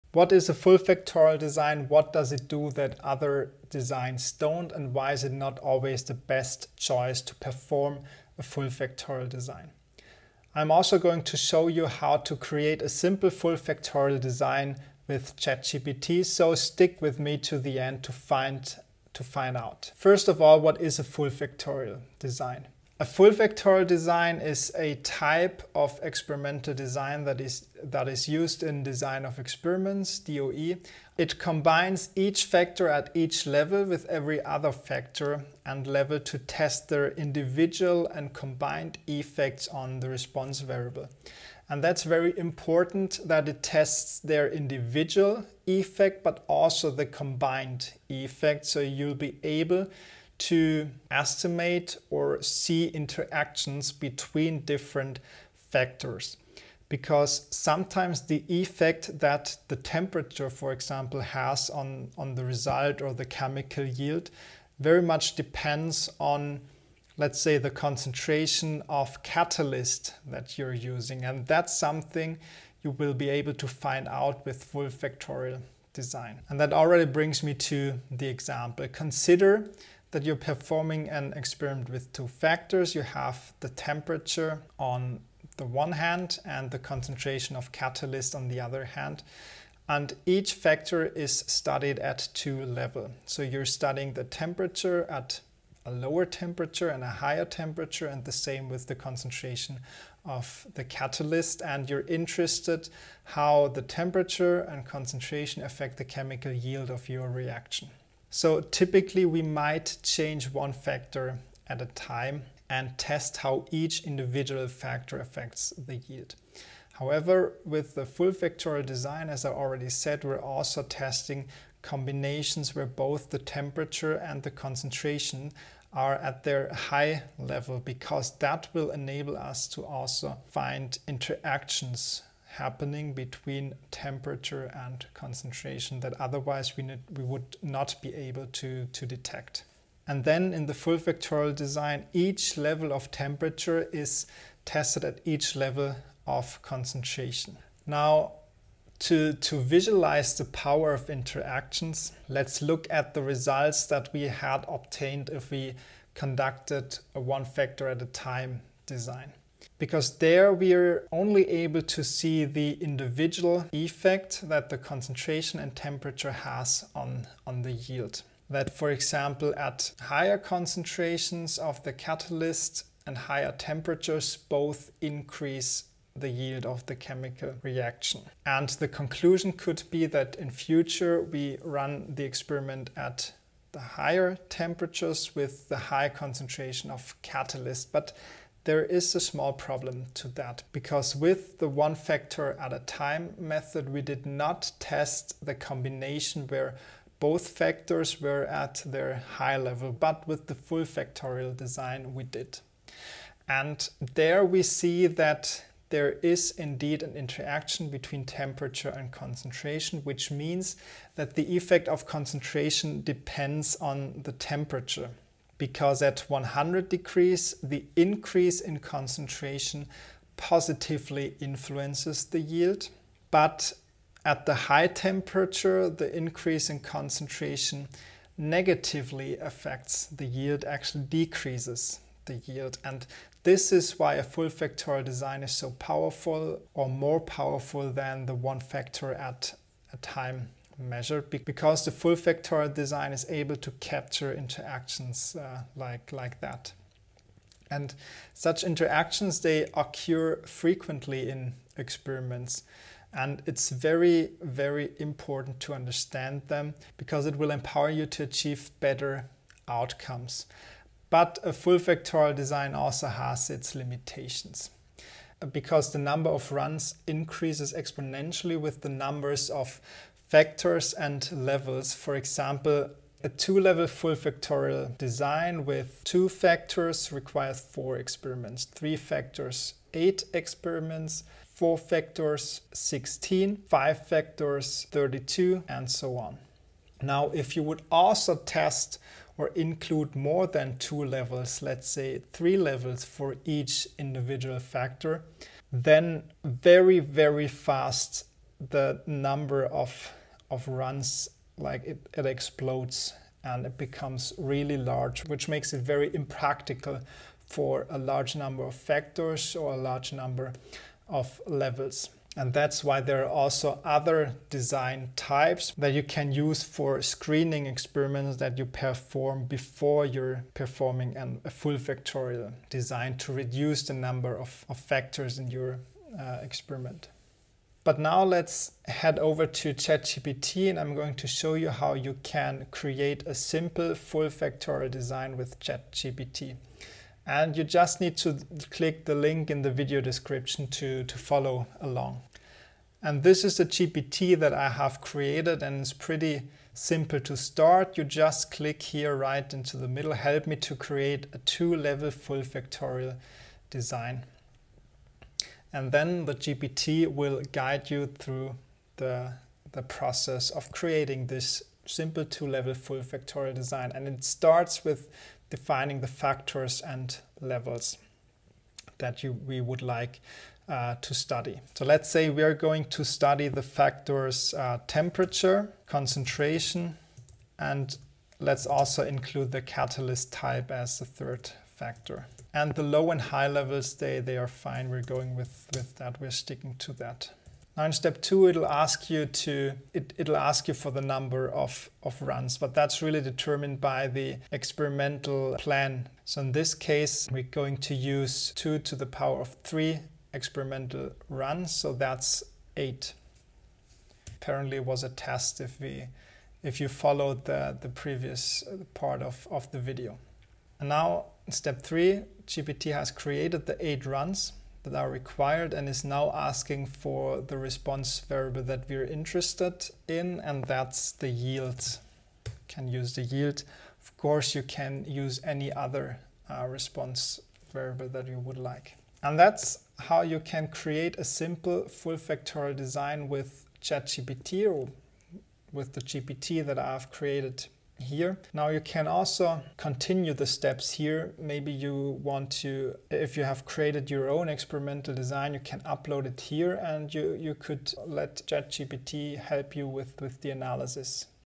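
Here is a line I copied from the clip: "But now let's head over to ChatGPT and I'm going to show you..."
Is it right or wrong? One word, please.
right.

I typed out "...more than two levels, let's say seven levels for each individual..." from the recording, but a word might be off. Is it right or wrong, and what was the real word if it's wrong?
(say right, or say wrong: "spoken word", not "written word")
wrong: "three", not "seven".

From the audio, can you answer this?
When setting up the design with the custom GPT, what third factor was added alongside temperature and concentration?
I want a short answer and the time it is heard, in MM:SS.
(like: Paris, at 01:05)
catalyst type, at 06:19.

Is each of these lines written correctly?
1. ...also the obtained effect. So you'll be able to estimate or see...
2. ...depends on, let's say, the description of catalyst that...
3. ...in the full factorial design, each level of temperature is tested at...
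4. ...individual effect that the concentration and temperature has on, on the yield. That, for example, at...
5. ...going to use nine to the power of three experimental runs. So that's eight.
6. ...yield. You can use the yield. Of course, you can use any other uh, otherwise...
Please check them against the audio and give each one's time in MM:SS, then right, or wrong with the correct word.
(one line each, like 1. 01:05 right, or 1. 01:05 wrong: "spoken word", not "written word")
1. 00:46 wrong: "combined", not "obtained"
2. 01:05 wrong: "concentration", not "description"
3. 02:20 right
4. 02:42 right
5. 06:37 wrong: "two", not "nine"
6. 07:01 wrong: "response", not "otherwise".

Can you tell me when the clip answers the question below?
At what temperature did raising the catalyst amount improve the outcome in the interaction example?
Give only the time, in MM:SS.
03:36.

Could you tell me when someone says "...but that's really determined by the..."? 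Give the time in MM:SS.
06:32.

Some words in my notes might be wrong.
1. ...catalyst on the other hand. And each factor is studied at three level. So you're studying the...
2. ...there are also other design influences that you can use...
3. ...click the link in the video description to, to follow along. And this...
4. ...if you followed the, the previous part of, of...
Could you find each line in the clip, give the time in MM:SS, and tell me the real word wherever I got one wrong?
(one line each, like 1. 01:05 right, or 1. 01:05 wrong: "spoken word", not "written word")
1. 01:27 wrong: "two", not "three"
2. 05:13 wrong: "types", not "influences"
3. 05:38 right
4. 06:46 right.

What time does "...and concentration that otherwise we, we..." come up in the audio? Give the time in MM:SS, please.
02:14.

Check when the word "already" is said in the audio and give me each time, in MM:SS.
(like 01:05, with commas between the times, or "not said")
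01:16, 01:59.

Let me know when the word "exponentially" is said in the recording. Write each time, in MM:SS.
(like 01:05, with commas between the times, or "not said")
04:27.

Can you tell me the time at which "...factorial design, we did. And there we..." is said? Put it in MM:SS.
03:20.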